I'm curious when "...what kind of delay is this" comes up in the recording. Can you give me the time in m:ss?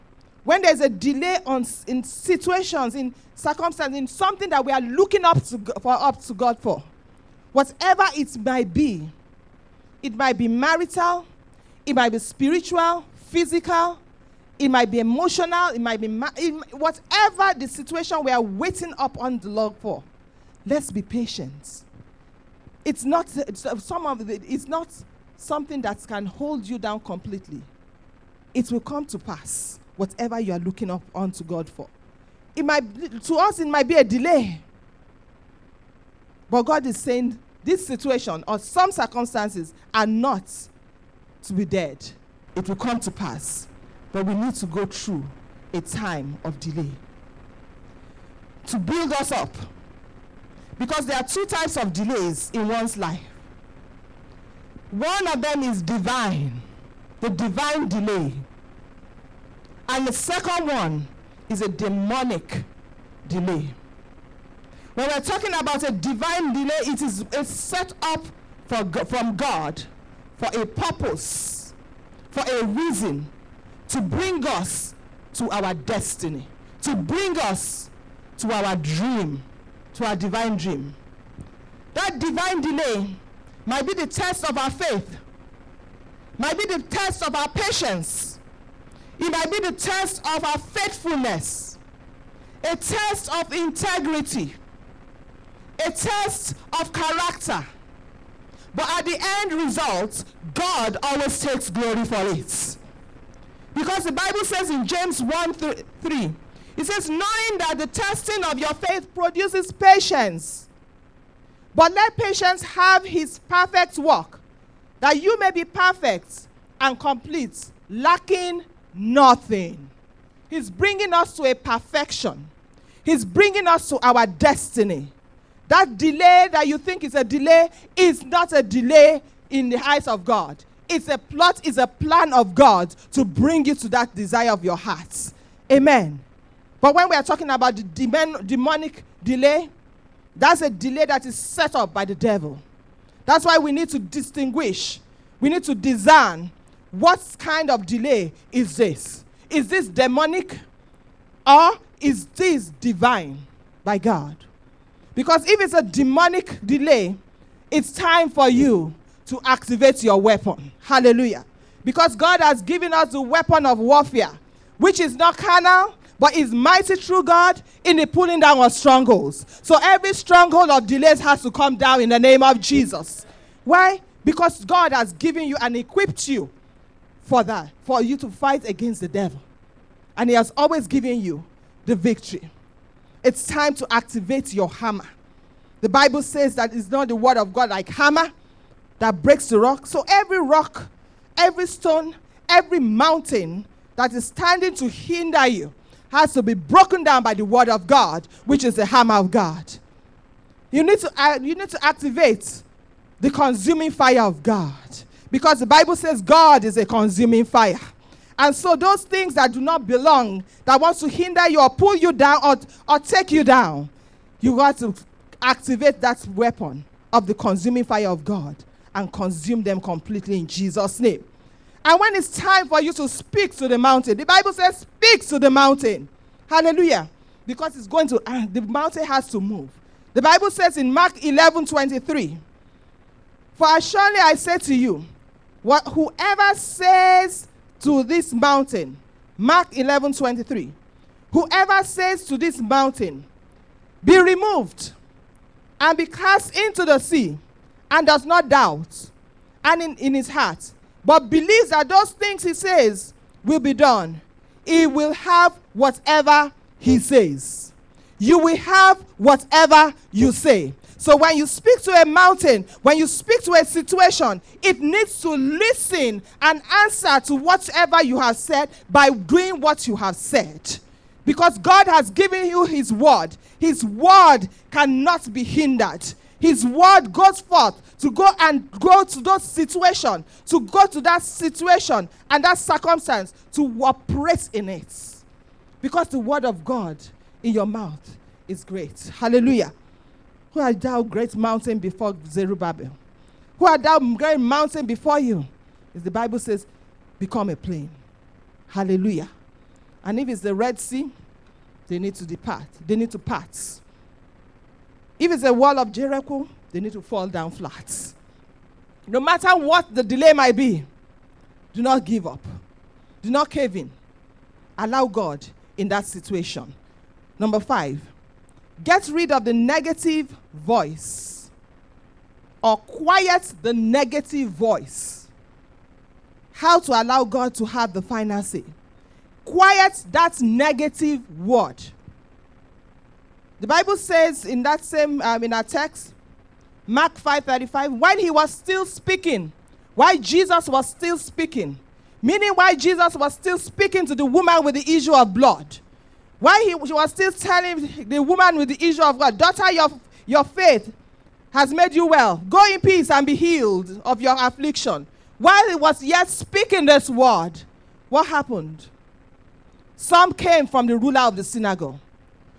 2:26.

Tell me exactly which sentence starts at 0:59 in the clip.
And the second one is a demonic delay.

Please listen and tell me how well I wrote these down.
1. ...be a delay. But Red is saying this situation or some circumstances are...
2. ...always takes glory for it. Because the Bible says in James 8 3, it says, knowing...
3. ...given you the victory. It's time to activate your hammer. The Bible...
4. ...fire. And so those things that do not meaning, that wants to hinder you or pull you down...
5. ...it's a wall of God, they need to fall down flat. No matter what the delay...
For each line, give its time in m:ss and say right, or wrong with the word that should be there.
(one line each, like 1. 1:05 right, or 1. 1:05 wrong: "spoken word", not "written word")
1. 0:33 wrong: "God", not "Red"
2. 1:41 wrong: "1", not "8"
3. 3:00 right
4. 3:27 wrong: "belong", not "meaning"
5. 5:05 wrong: "Jericho", not "God".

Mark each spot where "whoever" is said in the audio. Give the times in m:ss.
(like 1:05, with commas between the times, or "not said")
3:55, 4:01.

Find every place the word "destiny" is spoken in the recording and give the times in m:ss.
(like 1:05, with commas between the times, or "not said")
1:15, 2:04.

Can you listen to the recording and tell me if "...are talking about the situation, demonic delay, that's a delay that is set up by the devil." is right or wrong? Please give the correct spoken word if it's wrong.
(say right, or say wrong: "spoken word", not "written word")
wrong: "demon", not "situation".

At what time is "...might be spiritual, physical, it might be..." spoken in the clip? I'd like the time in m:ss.
0:11.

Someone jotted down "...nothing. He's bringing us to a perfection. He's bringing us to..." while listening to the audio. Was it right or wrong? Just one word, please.
right.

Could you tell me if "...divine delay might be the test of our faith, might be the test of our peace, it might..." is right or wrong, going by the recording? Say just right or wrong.
wrong.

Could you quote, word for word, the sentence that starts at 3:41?
And when it's time for you to speak to the mountain, the Bible says, speak to the mountain.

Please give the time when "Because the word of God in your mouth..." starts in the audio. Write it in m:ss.
4:45.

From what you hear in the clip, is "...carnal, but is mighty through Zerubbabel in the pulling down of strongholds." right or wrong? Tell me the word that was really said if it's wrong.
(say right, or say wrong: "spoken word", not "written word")
wrong: "God", not "Zerubbabel".